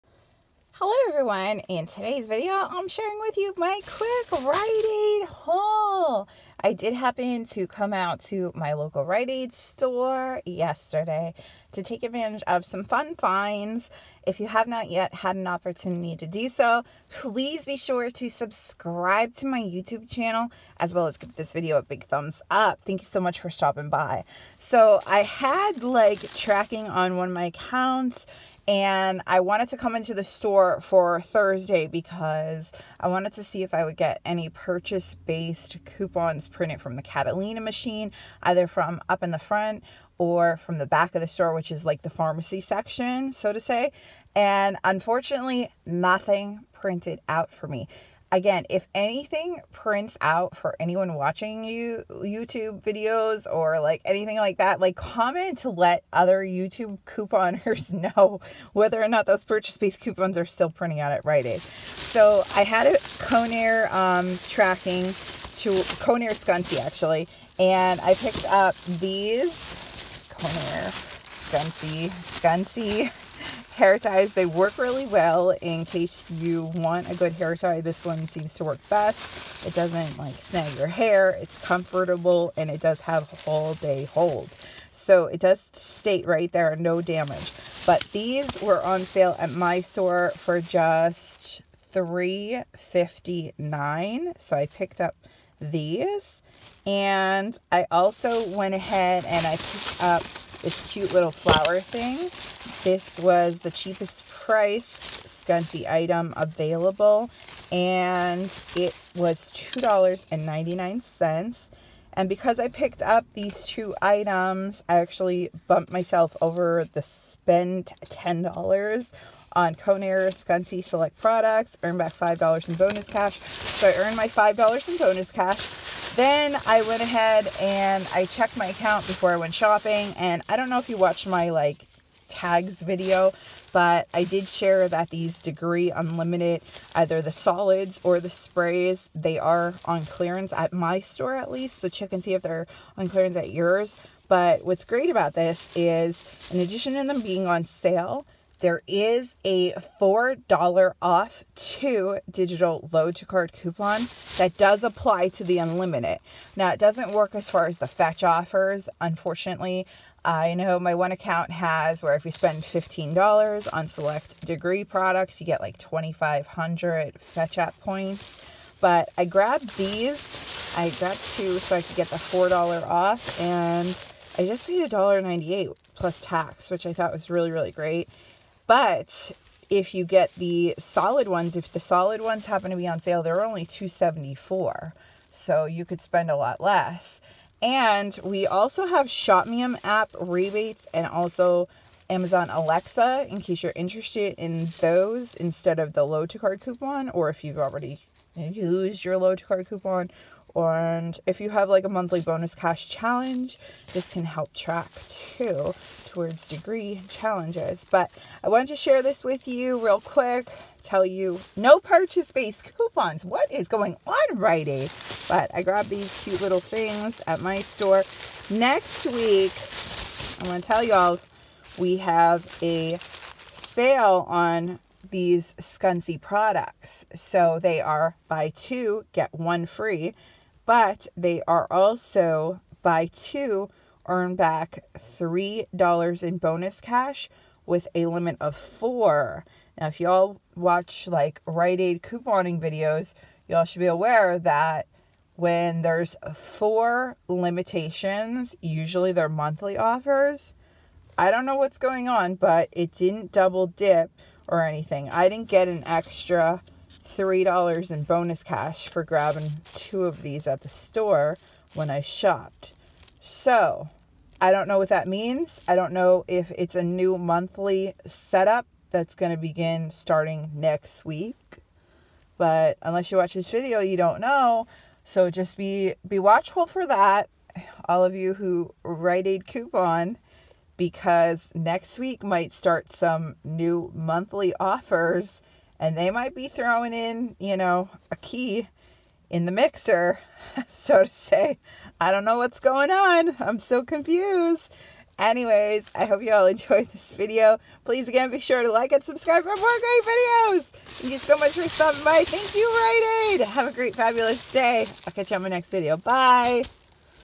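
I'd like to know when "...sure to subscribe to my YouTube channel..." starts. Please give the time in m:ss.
0:17.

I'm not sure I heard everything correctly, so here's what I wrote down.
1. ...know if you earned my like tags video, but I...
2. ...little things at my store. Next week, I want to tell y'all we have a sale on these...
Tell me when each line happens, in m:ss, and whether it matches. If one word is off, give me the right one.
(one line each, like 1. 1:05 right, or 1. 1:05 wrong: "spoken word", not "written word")
1. 2:10 wrong: "watched", not "earned"
2. 3:36 right.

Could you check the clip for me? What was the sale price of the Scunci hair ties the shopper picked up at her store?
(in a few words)
$3.59.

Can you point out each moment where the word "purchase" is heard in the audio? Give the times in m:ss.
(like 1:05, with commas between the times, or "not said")
0:34, 0:59, 3:31.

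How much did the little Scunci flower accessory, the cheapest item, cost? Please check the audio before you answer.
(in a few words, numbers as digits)
$2.99.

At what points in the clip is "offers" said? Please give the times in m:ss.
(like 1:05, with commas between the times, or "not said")
2:38, 4:09, 4:44.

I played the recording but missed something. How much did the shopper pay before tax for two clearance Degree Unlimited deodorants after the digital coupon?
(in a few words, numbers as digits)
$1.98.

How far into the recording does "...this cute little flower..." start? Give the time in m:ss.
1:40.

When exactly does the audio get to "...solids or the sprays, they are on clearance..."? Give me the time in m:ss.
2:17.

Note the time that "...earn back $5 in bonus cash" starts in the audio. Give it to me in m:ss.
2:01.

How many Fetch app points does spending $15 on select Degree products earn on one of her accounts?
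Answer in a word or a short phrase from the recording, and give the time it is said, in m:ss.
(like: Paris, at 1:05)
2,500, at 2:45.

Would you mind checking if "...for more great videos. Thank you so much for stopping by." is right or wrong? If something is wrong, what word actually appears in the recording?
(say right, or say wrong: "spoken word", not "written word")
right.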